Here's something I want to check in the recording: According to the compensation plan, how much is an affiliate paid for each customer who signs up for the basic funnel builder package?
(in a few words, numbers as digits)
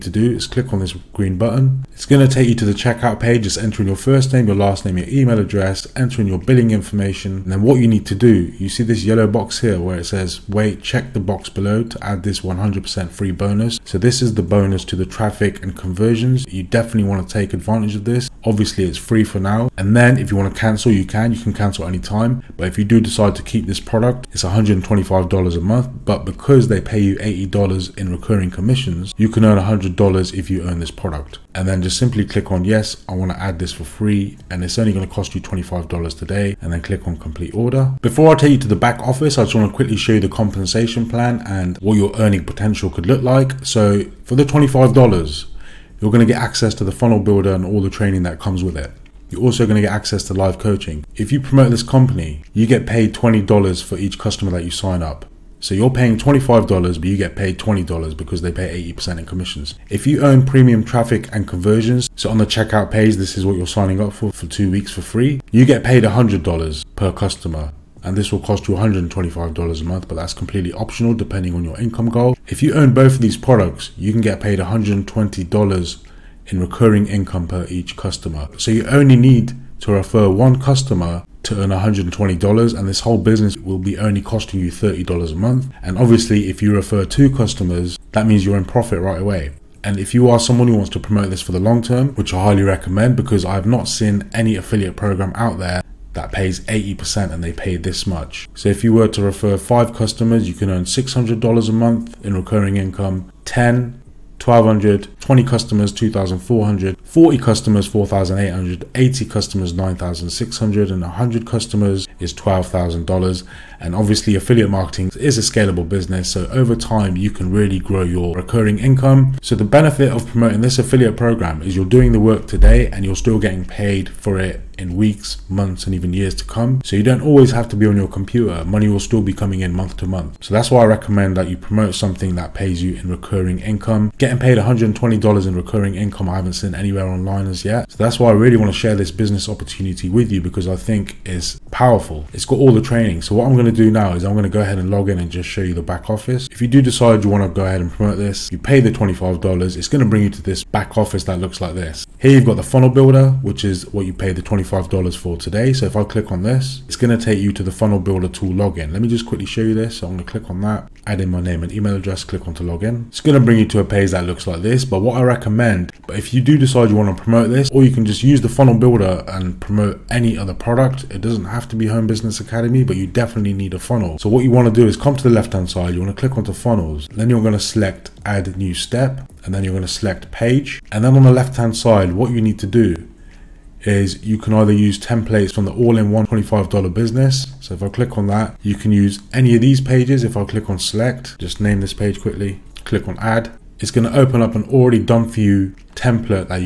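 $20.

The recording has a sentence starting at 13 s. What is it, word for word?
So this is the bonus to the traffic and conversions.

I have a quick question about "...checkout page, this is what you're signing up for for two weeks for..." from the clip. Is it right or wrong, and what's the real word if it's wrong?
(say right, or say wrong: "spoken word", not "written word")
right.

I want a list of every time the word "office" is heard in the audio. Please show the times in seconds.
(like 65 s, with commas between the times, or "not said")
38 s, 146 s, 150 s.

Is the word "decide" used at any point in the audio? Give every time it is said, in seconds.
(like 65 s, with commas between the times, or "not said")
22 s, 146 s, 166 s.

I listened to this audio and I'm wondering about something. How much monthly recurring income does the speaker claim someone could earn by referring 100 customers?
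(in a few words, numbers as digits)
$12,000.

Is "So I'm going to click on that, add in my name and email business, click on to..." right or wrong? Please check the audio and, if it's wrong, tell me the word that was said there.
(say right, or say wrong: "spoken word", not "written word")
wrong: "address", not "business".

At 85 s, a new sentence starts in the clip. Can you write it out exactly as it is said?
And obviously, if you refer two customers, that means you're in profit right away.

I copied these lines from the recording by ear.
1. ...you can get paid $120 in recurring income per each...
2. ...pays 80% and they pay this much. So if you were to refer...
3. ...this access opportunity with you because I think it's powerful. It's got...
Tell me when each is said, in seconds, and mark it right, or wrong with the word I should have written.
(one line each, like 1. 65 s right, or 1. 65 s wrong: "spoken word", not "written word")
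1. 73 s right
2. 96 s right
3. 138 s wrong: "business", not "access".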